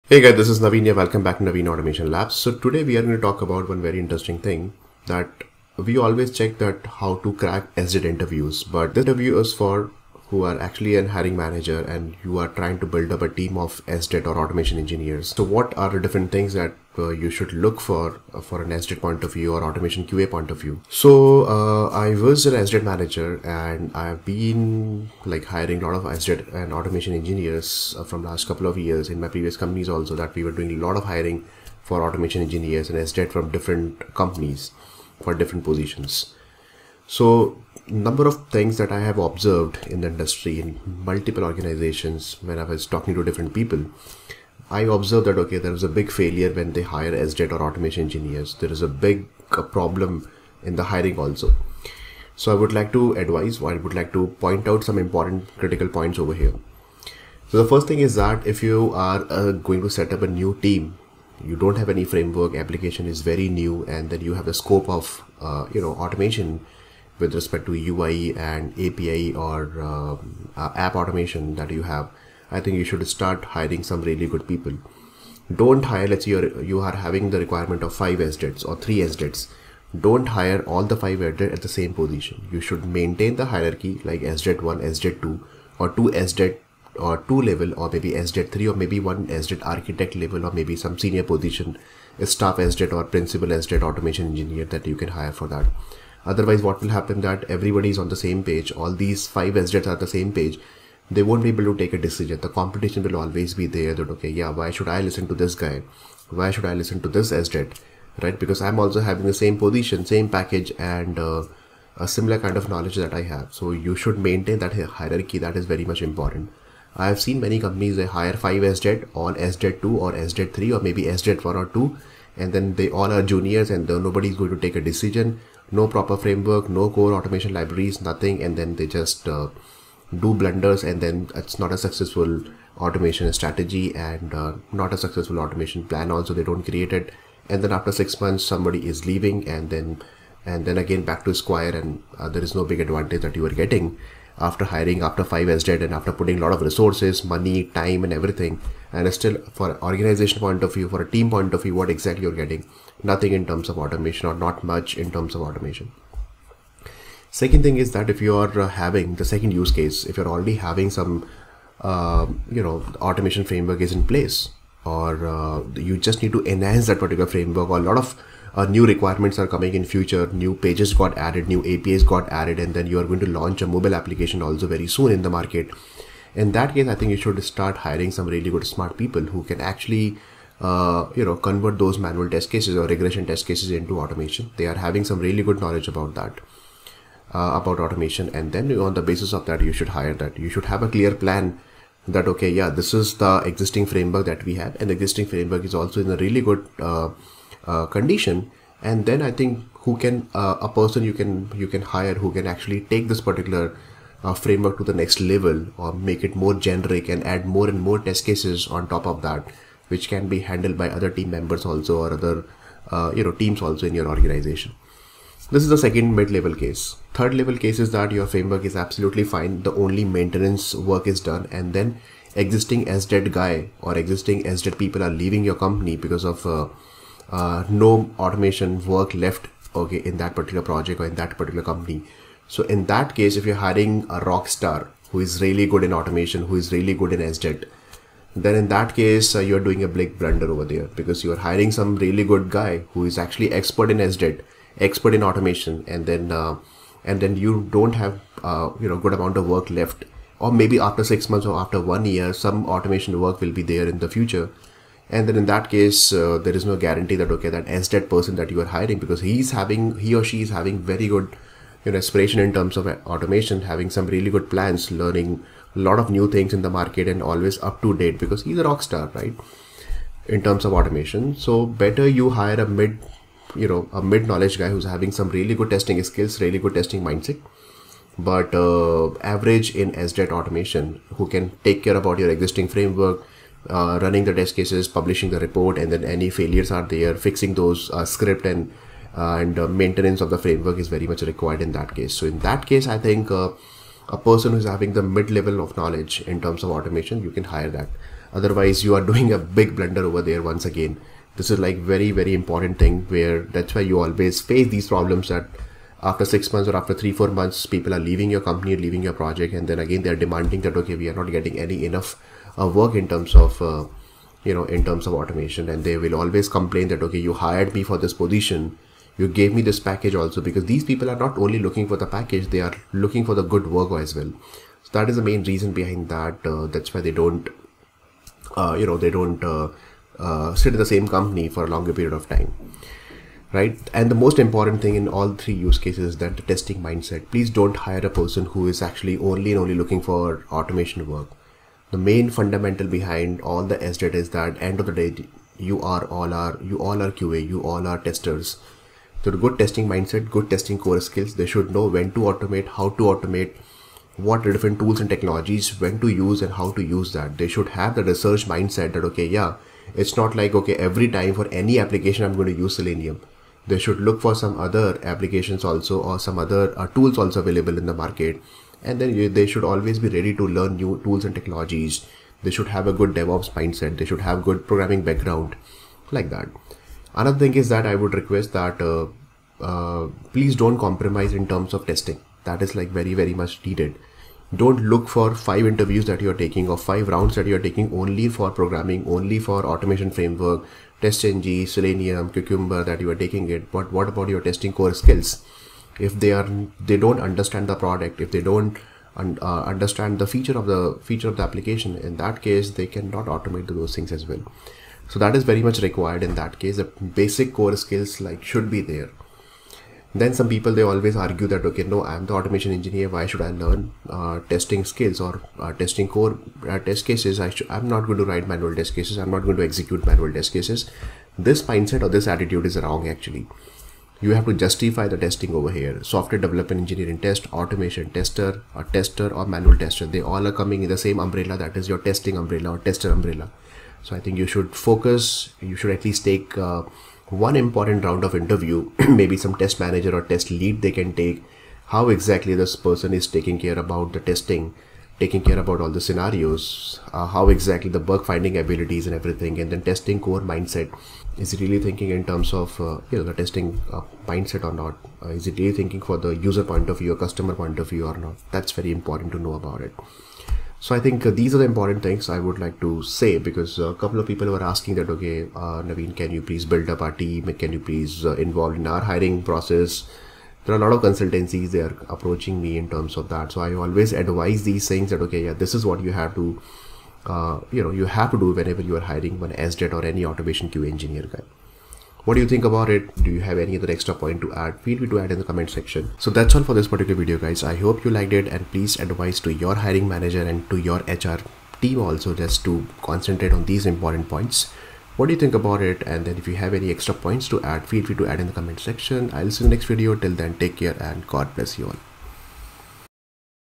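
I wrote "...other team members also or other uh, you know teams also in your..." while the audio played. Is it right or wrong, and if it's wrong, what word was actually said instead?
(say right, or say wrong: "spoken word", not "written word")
right.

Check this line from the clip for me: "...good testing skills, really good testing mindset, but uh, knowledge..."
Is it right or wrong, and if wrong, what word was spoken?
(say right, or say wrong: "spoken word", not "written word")
wrong: "average", not "knowledge".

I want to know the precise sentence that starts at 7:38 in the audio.
That's very important to know about it.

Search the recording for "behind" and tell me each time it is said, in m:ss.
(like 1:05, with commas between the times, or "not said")
5:25, 5:42.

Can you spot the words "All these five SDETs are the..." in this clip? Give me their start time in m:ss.
1:38.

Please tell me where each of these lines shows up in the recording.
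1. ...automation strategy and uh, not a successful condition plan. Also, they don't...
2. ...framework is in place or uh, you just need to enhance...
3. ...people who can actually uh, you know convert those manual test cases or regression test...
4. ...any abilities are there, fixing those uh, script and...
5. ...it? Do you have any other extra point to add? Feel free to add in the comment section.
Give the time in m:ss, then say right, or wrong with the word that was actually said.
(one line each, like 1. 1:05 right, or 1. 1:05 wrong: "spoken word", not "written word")
1. 2:12 wrong: "automation", not "condition"
2. 2:43 right
3. 2:58 right
4. 4:46 wrong: "failures", not "abilities"
5. 8:02 right.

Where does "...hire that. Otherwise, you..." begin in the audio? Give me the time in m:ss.
4:57.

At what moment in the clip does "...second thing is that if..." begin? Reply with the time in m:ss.
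2:37.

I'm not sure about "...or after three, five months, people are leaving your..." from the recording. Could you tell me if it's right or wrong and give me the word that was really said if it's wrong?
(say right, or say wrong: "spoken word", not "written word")
wrong: "four", not "five".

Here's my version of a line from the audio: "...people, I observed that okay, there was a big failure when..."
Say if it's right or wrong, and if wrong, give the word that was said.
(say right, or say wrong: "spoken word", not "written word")
right.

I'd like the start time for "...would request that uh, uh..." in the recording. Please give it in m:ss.
6:17.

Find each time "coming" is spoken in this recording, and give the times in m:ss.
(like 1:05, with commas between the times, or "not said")
2:49, 7:10.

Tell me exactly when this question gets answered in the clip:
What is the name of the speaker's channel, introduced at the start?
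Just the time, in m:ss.
0:01.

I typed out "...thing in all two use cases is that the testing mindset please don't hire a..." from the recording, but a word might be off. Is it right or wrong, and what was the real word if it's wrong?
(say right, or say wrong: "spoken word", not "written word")
wrong: "three", not "two".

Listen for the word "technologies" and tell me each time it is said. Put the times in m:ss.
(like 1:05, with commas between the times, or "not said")
5:55, 6:11.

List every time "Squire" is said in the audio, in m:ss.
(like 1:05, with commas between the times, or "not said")
2:21.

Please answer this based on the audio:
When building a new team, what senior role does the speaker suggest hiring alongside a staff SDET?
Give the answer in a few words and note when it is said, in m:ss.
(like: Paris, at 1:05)
principal SDET, at 1:33.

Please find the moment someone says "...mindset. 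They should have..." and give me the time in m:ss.
6:13.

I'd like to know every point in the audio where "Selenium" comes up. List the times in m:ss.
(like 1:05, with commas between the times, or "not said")
6:02, 6:31.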